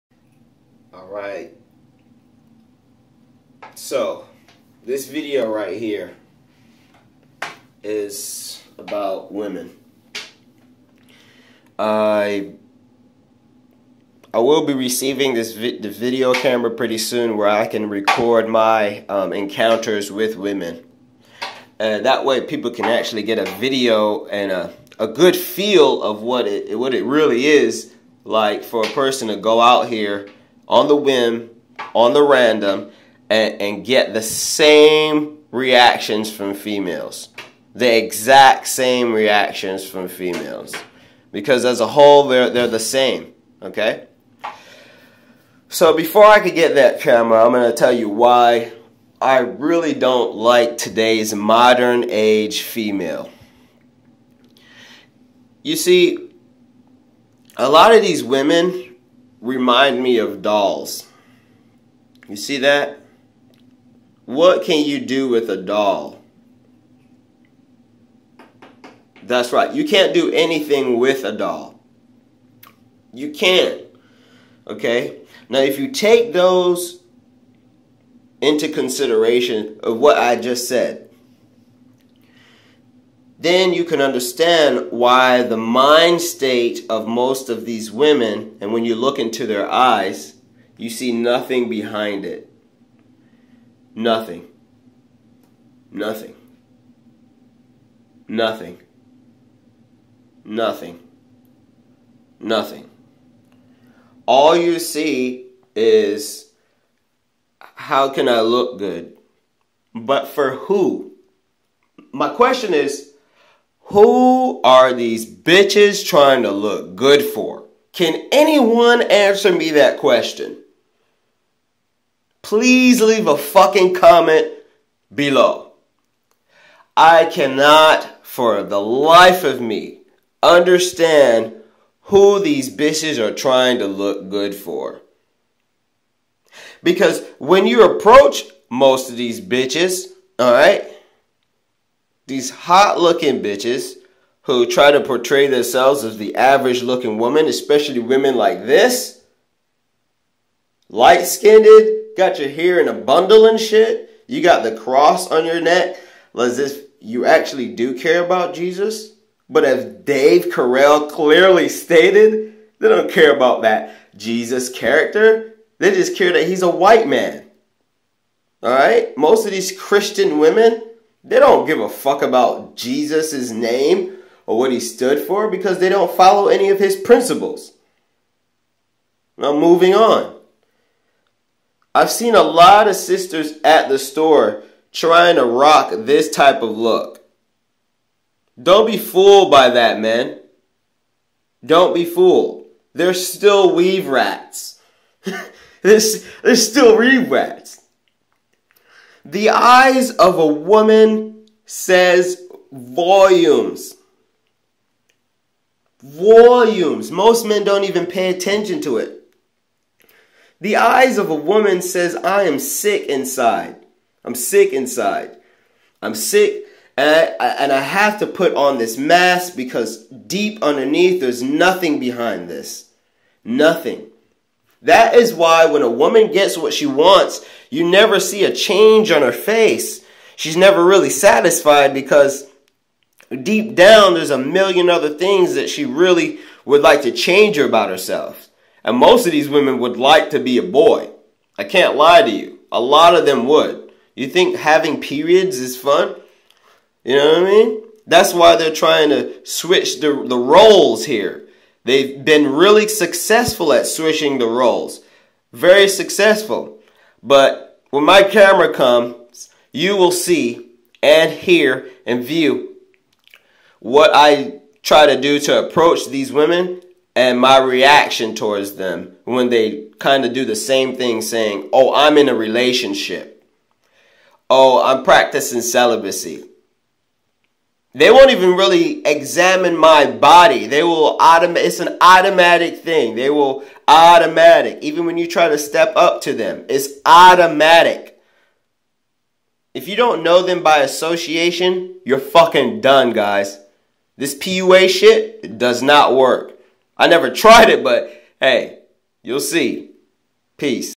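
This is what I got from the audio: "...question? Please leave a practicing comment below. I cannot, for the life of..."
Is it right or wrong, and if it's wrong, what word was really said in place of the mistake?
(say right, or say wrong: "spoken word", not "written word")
wrong: "fucking", not "practicing".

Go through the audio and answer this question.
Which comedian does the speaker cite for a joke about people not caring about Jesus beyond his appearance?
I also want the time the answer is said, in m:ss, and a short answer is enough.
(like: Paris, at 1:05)
Dave Carell, at 2:39.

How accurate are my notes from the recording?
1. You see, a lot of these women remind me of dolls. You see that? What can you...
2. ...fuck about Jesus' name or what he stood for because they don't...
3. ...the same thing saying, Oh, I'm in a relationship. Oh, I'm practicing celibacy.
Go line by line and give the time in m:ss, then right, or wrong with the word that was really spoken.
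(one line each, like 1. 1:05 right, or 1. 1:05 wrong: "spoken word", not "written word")
1. 0:55 right
2. 2:51 right
3. 4:30 right.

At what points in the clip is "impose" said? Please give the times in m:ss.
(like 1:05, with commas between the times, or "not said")
not said.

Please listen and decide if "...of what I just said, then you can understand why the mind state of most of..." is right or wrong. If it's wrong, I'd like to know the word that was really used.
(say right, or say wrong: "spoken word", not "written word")
right.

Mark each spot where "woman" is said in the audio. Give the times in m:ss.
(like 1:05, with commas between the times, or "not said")
2:27, 3:20, 3:31, 3:45.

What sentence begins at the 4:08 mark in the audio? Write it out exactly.
That's why they're trying to switch the, the roles here.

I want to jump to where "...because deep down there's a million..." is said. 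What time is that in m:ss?
3:51.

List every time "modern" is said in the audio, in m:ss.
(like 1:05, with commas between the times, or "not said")
0:51.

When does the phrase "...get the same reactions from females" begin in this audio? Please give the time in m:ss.
0:33.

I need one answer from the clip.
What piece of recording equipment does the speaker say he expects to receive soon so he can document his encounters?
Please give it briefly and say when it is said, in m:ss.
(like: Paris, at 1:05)
video camera, at 0:15.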